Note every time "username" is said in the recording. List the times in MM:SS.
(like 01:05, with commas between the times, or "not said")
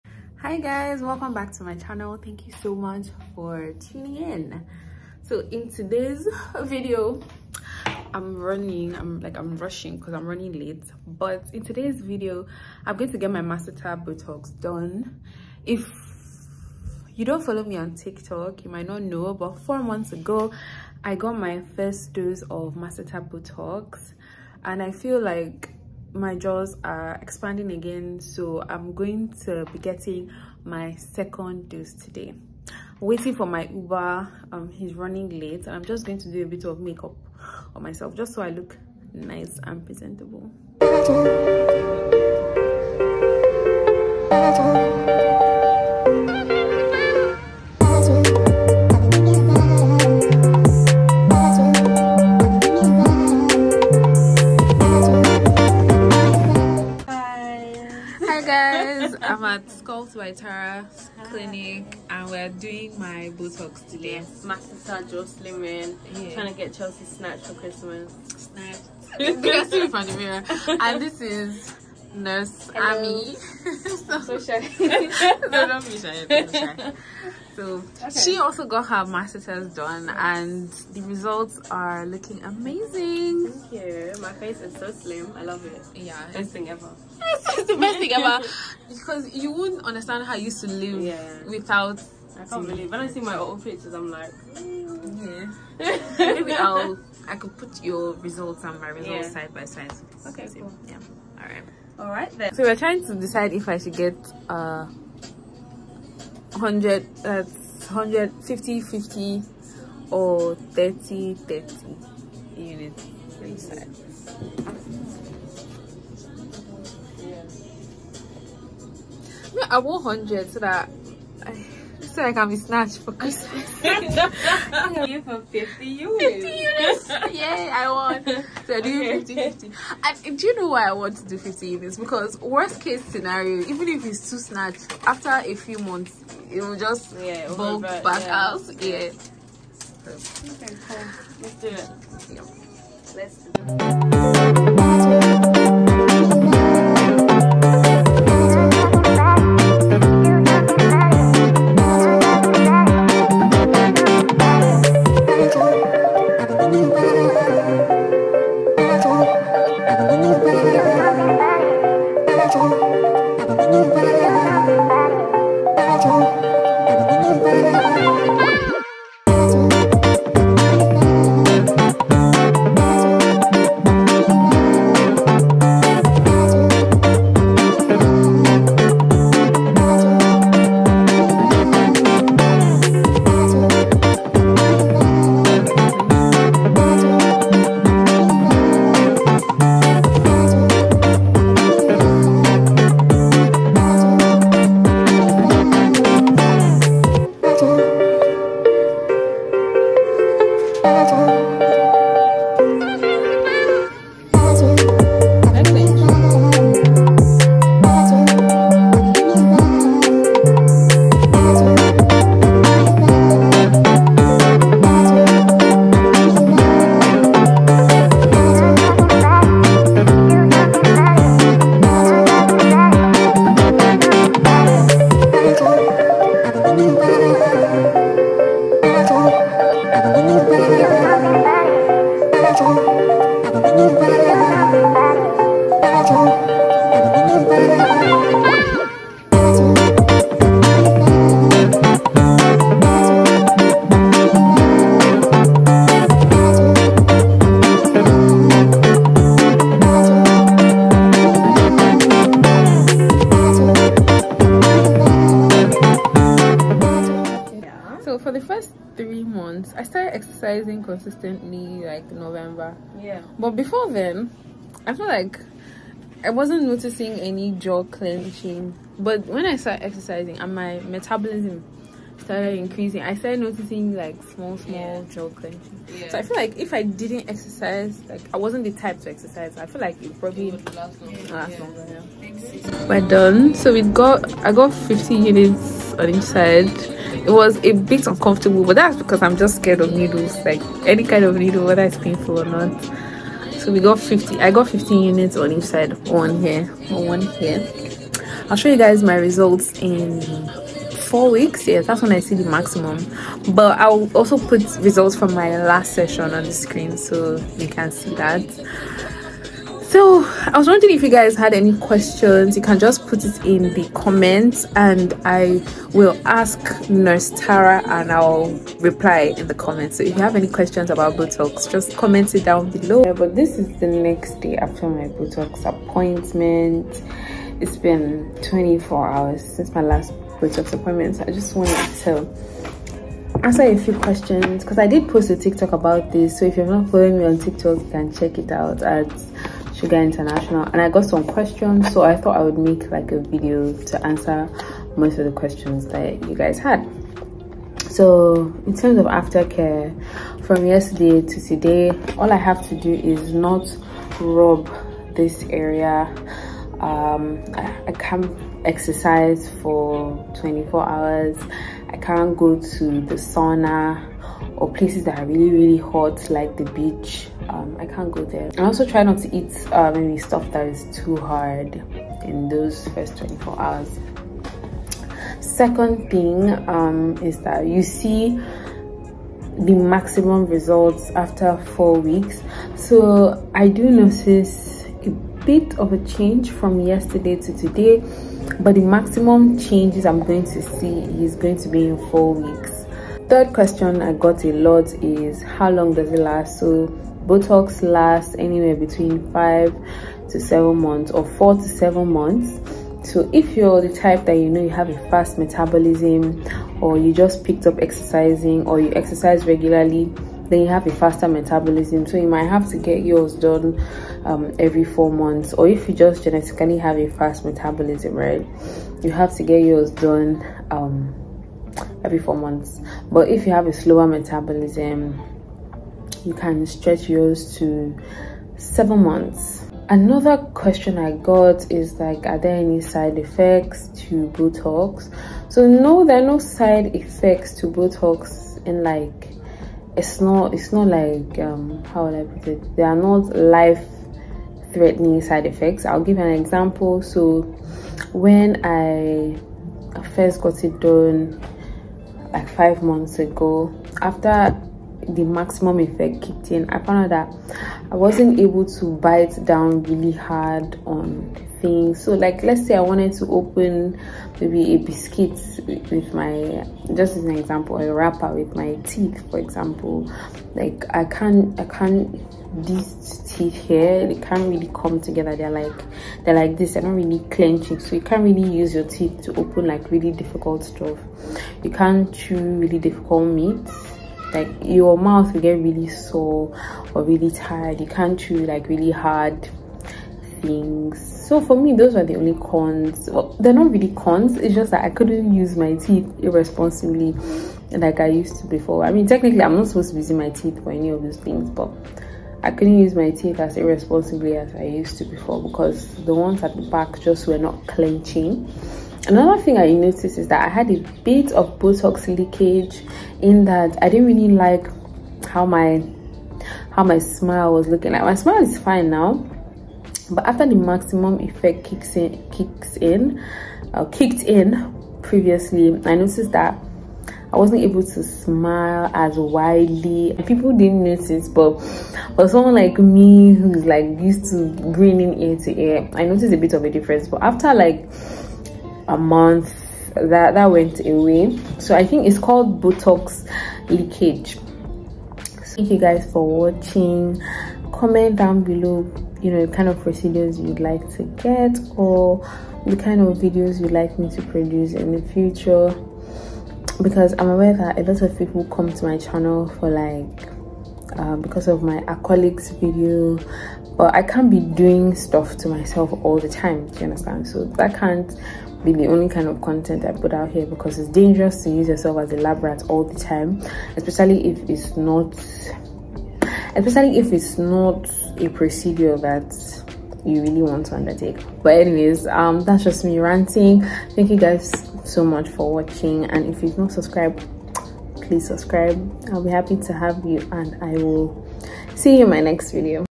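not said.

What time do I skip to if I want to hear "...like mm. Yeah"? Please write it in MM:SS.
01:34.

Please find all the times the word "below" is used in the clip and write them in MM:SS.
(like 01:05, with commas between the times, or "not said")
05:22, 09:08.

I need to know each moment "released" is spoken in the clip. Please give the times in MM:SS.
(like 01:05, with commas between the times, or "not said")
not said.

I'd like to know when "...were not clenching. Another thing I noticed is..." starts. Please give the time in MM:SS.
08:27.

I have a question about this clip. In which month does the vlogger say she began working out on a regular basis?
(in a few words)
November.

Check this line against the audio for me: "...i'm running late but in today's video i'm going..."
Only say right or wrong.
right.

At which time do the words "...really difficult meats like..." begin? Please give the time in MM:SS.
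08:02.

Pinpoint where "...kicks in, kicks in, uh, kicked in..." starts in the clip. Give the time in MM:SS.
08:41.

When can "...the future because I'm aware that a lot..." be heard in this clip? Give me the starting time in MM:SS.
09:14.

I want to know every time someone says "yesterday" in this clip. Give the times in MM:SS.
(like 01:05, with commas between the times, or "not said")
05:50, 06:26.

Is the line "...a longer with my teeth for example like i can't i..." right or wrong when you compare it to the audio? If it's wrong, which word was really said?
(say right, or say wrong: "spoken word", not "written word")
wrong: "wrapper", not "longer".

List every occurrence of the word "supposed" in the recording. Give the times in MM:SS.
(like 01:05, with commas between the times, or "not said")
08:19.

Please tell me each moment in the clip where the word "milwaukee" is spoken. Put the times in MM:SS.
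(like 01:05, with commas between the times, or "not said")
not said.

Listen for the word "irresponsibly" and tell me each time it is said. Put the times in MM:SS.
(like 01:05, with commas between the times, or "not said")
08:16, 08:23.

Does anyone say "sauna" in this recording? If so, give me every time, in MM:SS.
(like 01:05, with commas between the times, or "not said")
06:03.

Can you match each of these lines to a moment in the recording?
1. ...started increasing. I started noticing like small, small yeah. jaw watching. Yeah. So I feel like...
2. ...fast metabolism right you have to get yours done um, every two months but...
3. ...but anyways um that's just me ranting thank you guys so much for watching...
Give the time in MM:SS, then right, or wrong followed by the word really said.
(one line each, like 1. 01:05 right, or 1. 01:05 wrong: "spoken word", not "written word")
1. 04:32 wrong: "clenching", not "watching"
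2. 06:57 wrong: "four", not "two"
3. 09:41 right.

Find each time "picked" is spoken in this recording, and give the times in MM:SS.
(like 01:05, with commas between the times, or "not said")
06:47.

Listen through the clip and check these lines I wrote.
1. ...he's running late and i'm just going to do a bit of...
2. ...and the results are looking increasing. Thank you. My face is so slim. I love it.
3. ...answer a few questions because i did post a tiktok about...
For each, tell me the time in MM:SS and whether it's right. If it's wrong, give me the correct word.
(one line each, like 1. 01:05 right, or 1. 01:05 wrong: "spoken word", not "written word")
1. 00:34 right
2. 01:20 wrong: "amazing", not "increasing"
3. 05:33 right.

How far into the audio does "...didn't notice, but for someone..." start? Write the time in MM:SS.
08:50.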